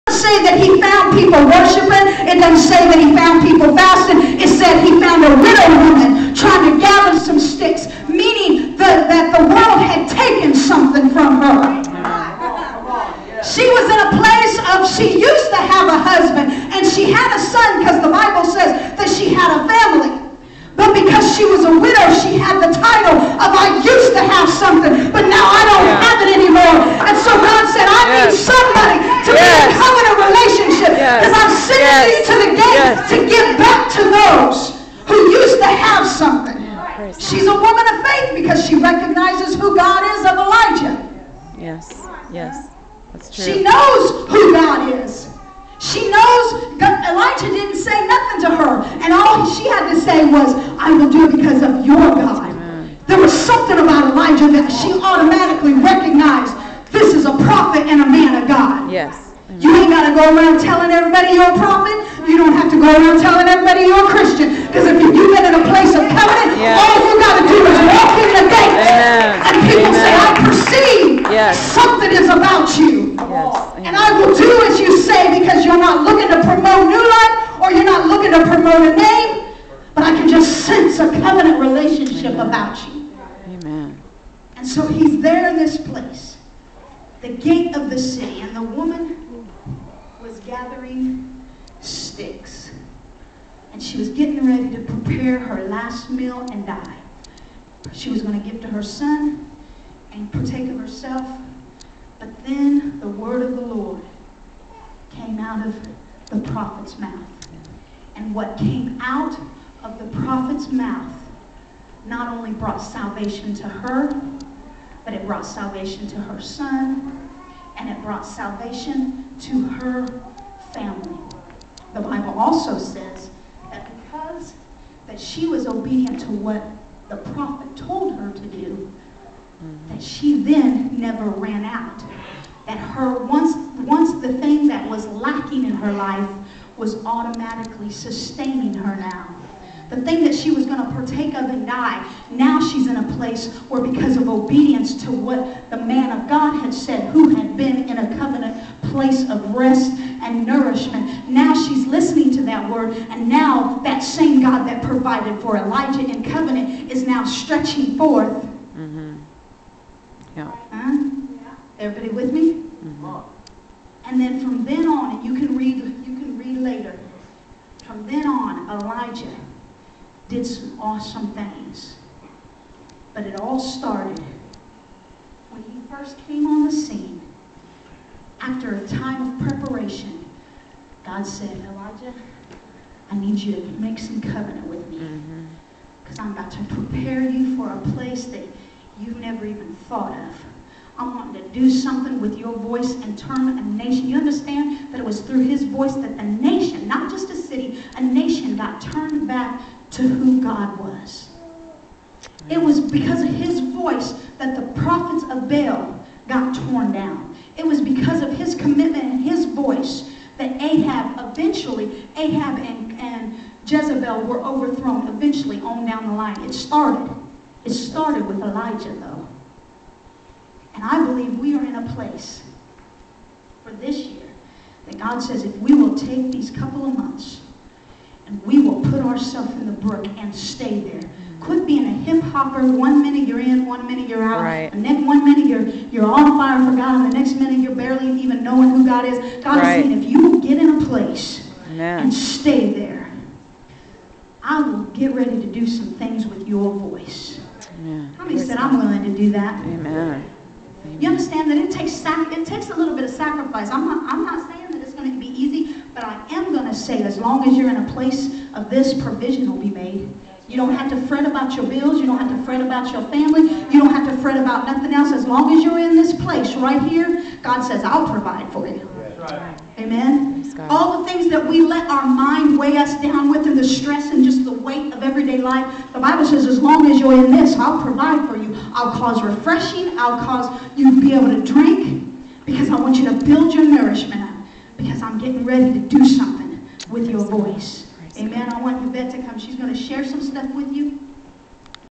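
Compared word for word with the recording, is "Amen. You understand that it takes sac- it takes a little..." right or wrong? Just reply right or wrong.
right.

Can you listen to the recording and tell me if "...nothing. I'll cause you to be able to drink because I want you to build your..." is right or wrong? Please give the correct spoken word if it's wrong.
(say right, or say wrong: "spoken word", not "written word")
wrong: "refreshing", not "nothing".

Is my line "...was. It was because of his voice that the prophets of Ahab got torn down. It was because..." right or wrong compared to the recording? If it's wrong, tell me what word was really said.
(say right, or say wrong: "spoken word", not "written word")
wrong: "Baal", not "Ahab".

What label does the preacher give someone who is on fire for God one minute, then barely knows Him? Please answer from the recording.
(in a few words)
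hip hopper.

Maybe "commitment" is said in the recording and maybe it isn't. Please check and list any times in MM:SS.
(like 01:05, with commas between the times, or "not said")
03:28.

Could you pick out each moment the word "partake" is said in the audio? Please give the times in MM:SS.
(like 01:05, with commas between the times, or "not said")
01:40, 02:20.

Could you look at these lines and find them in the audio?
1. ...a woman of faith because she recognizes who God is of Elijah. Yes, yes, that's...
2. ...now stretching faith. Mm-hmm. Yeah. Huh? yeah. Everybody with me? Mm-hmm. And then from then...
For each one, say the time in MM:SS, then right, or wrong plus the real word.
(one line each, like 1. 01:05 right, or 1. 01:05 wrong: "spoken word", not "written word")
1. 00:37 right
2. 02:37 wrong: "forth", not "faith".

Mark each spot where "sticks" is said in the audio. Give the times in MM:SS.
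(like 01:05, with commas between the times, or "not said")
00:07, 01:31.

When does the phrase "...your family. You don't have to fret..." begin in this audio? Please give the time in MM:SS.
04:22.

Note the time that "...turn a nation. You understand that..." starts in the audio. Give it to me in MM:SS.
03:13.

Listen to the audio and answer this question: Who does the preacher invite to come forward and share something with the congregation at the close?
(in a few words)
Yvette.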